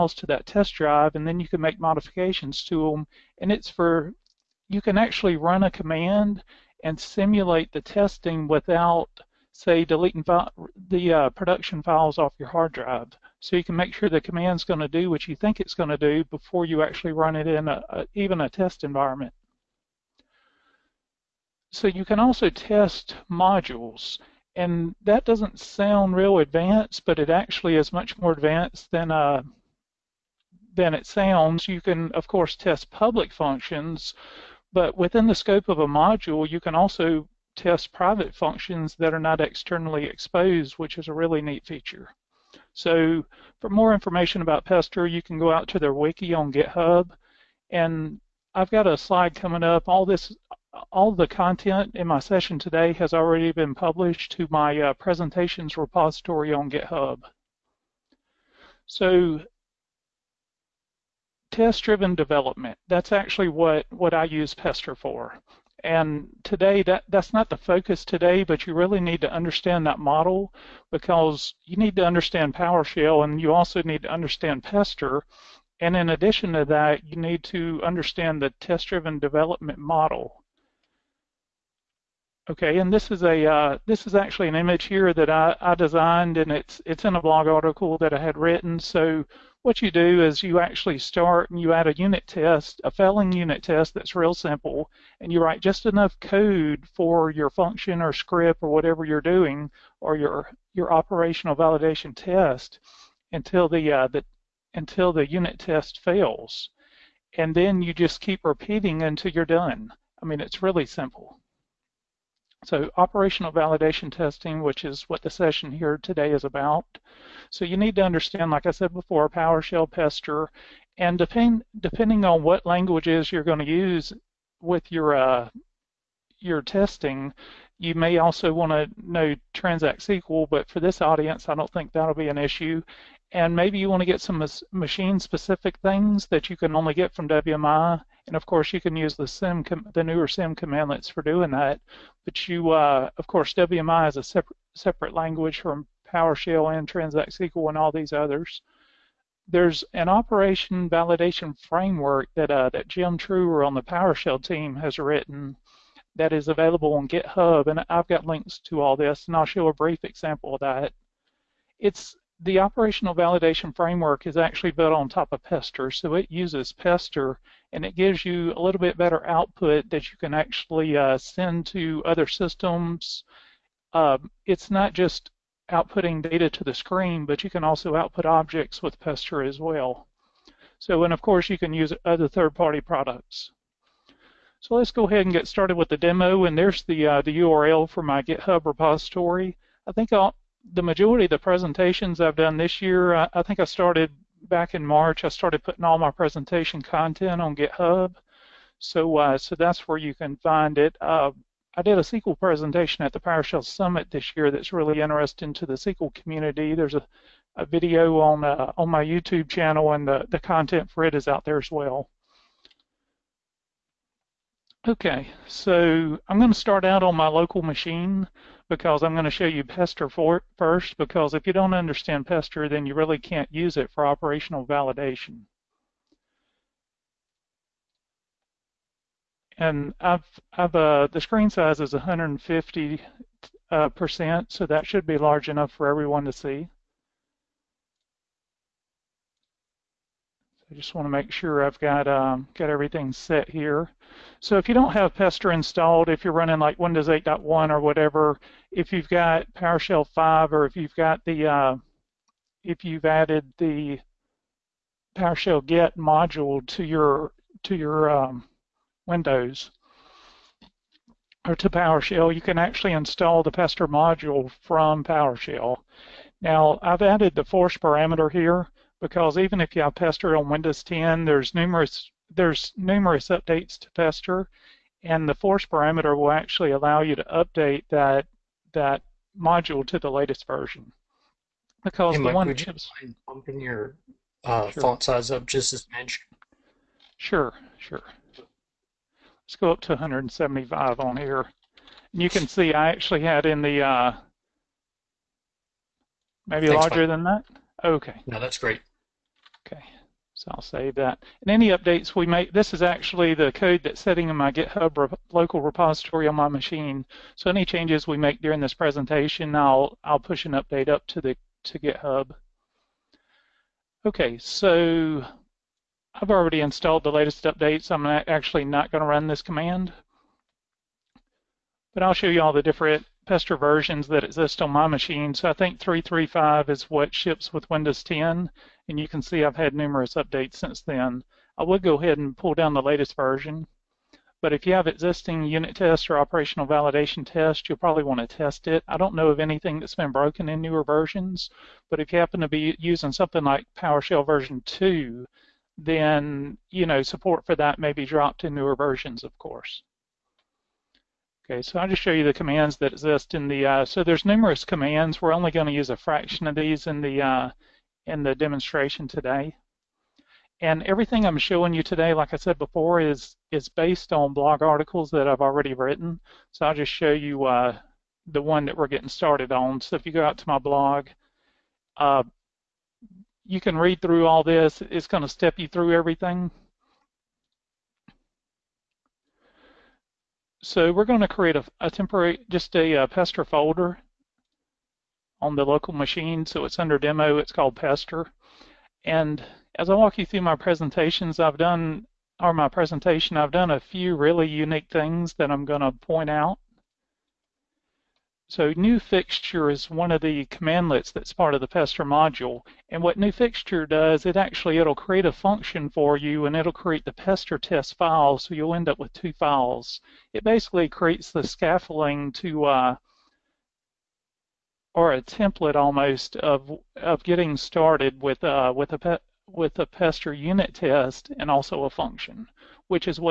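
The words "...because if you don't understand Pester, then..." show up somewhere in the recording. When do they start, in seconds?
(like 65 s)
220 s.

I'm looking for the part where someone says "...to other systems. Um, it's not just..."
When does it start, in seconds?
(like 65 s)
171 s.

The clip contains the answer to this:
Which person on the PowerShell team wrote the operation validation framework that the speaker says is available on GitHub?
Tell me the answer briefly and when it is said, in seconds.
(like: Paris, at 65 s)
Jim Truher, at 152 s.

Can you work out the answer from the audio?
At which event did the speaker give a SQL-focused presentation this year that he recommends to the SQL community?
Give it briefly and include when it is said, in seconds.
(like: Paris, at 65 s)
PowerShell Summit, at 203 s.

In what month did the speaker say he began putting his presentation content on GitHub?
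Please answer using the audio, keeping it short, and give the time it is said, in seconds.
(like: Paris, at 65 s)
March, at 194 s.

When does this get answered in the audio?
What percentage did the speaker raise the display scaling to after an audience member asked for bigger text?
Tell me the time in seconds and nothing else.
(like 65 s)
289 s.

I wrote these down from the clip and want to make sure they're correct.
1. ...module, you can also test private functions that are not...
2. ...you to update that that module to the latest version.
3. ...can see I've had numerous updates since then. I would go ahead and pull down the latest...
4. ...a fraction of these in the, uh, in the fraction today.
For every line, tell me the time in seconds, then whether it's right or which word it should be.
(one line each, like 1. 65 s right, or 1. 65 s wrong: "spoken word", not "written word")
1. 35 s right
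2. 277 s right
3. 329 s right
4. 355 s wrong: "demonstration", not "fraction".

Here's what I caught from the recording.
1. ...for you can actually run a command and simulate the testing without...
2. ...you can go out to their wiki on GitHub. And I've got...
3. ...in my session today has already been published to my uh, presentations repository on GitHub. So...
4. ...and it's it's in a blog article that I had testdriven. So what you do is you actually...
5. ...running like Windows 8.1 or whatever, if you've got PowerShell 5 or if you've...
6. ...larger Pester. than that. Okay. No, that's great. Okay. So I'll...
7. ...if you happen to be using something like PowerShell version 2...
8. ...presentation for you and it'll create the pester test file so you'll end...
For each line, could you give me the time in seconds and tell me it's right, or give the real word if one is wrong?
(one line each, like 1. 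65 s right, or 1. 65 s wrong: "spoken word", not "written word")
1. 3 s right
2. 45 s right
3. 51 s right
4. 86 s wrong: "written", not "testdriven"
5. 246 s right
6. 296 s wrong: "Mike", not "Pester"
7. 341 s right
8. 405 s wrong: "function", not "presentation".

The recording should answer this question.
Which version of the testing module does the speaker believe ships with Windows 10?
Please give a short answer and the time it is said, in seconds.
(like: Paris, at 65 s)
335, at 325 s.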